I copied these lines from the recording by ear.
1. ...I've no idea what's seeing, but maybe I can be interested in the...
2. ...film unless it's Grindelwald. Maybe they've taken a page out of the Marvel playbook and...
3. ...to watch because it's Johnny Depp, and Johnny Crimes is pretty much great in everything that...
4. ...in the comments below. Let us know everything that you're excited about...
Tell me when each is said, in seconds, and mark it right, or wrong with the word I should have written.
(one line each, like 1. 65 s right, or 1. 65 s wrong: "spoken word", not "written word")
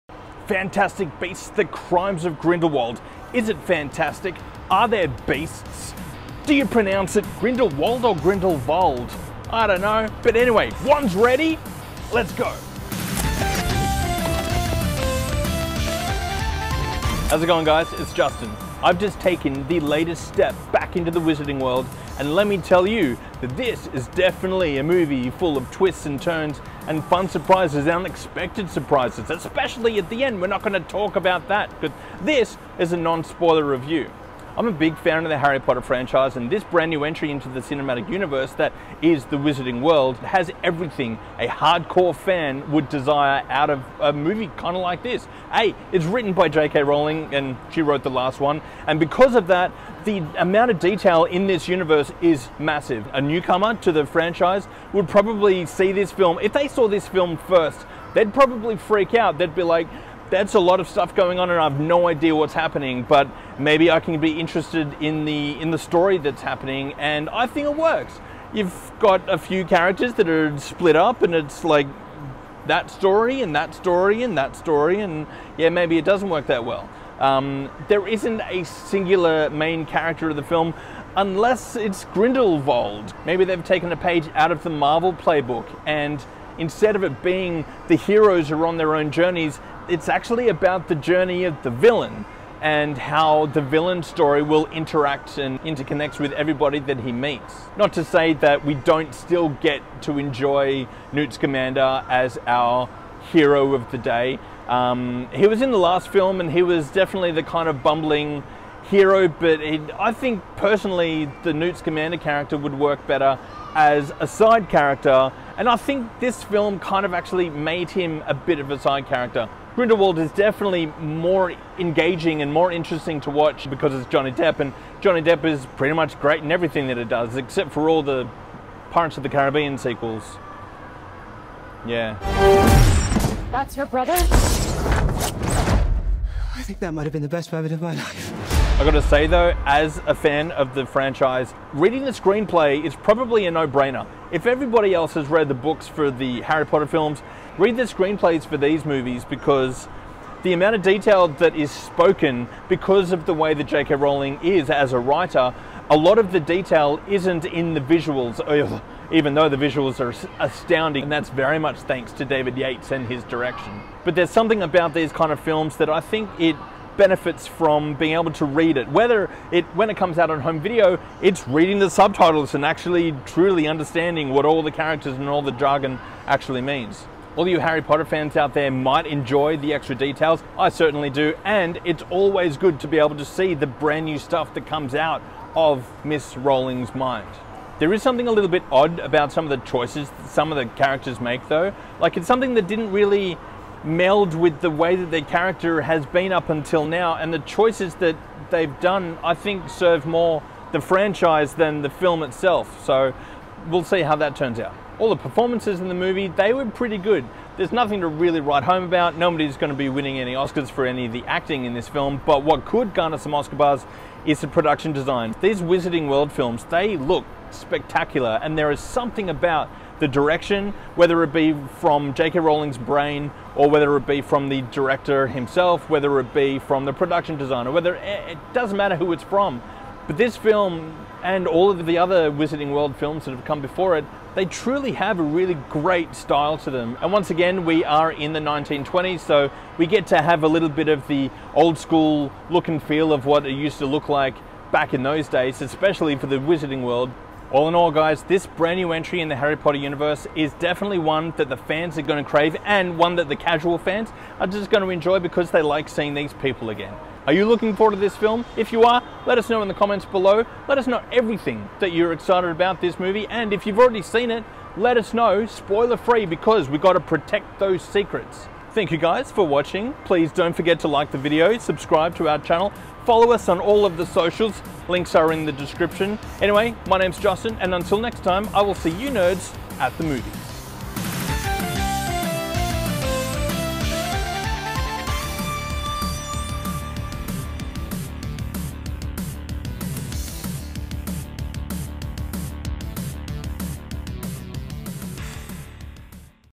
1. 61 s wrong: "happening", not "seeing"
2. 80 s right
3. 123 s wrong: "Depp", not "Crimes"
4. 259 s right.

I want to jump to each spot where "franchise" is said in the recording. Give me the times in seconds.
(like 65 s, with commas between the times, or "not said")
35 s, 54 s, 140 s, 200 s.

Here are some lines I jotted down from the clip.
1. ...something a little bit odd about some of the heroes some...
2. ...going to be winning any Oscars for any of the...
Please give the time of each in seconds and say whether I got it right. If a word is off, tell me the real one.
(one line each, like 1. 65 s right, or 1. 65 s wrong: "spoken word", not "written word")
1. 188 s wrong: "choices", not "heroes"
2. 209 s right.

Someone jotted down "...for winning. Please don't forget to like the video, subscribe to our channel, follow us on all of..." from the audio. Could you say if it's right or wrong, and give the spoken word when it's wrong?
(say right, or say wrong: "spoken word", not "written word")
wrong: "watching", not "winning".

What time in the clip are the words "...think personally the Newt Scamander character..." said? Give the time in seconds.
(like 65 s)
110 s.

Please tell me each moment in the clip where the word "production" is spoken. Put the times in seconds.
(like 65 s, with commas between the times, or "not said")
214 s, 226 s.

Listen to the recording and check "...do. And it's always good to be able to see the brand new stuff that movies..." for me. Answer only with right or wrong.
wrong.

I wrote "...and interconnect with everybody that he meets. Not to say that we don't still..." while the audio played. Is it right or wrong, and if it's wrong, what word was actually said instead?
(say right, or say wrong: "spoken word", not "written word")
right.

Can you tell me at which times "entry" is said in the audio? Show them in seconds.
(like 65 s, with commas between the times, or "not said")
37 s, 248 s.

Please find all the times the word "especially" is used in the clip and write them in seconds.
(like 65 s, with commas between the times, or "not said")
29 s, 245 s.